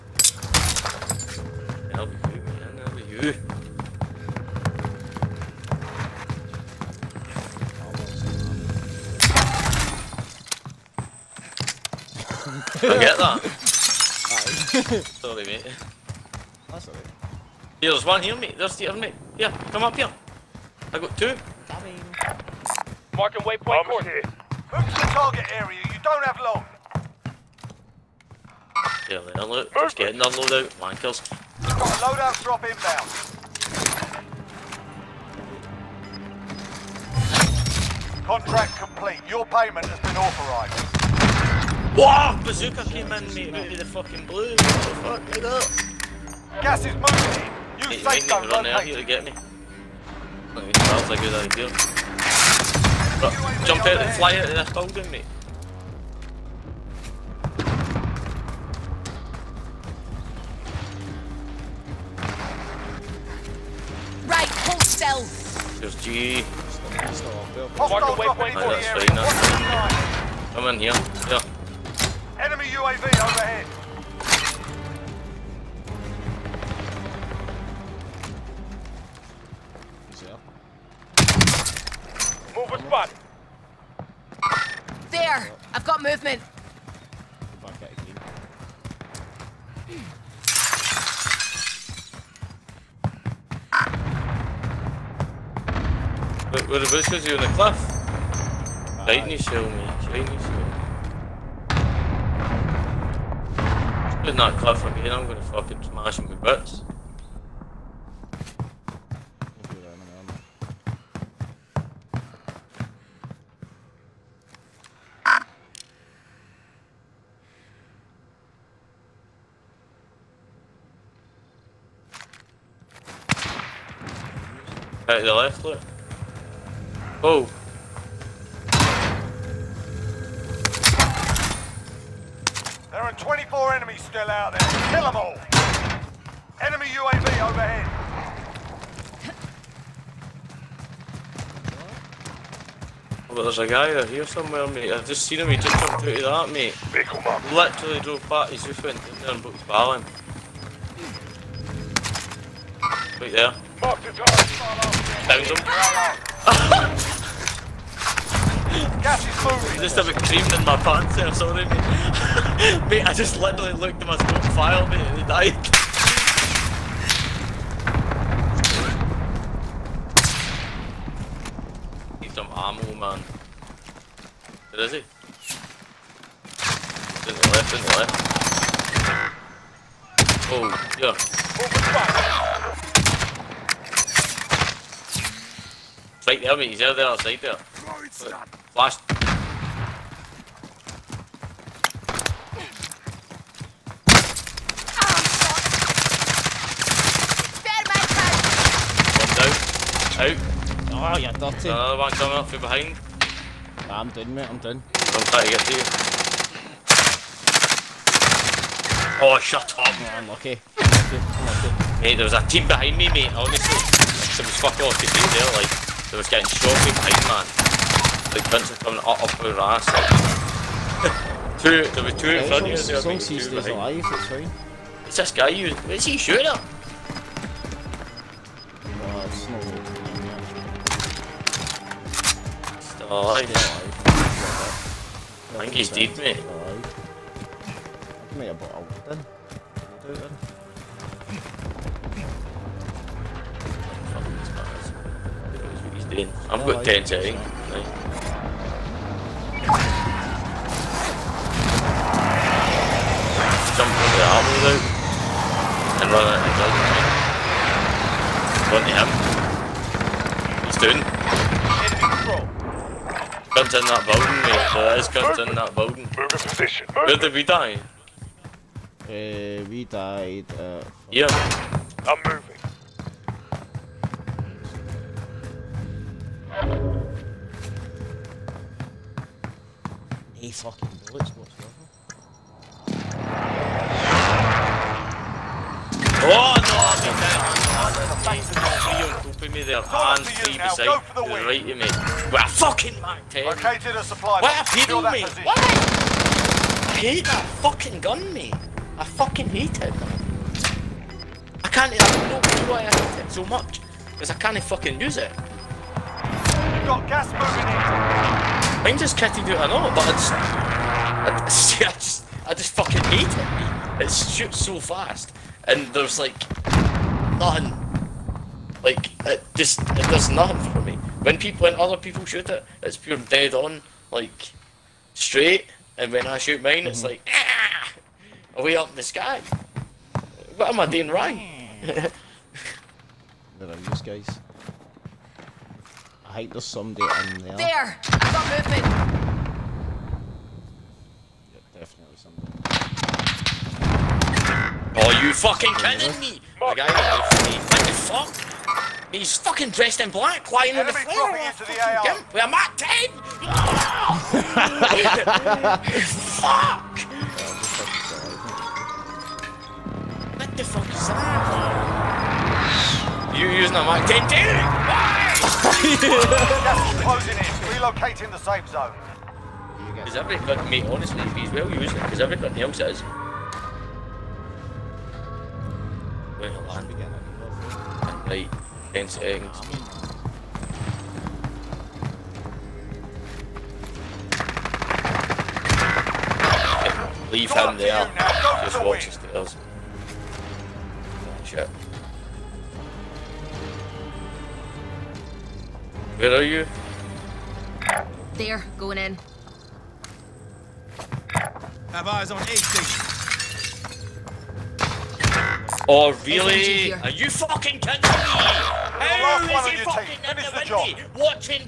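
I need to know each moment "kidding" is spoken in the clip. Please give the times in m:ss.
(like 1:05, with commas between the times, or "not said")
5:45, 6:47.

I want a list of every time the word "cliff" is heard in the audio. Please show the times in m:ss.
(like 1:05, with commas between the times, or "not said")
1:37, 1:44.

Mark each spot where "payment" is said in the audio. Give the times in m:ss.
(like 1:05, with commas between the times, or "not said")
0:39.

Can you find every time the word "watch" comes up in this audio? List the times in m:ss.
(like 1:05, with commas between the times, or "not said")
6:28.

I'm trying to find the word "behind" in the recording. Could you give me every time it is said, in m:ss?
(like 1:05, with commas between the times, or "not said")
3:22, 3:32, 3:36.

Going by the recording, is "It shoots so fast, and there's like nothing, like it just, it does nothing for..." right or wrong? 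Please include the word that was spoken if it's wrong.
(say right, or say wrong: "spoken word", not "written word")
right.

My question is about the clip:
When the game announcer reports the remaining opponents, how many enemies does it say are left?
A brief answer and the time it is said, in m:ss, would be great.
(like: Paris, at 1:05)
24, at 2:13.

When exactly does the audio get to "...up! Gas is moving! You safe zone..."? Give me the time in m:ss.
0:45.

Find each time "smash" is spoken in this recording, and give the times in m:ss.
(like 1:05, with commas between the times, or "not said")
1:45.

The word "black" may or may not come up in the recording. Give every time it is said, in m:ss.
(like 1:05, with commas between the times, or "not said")
5:50.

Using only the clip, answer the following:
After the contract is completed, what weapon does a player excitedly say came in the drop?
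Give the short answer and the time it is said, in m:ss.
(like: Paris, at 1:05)
Bazooka, at 0:42.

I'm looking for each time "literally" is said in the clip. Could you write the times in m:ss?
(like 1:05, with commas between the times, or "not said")
2:27, 2:43.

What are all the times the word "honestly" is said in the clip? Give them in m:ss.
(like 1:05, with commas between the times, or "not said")
3:33, 6:10.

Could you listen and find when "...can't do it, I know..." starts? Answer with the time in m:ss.
5:09.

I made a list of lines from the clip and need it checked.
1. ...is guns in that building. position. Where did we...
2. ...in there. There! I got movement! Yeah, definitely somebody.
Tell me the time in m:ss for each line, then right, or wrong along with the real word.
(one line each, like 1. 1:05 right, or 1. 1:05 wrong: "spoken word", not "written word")
1. 4:24 right
2. 5:37 right.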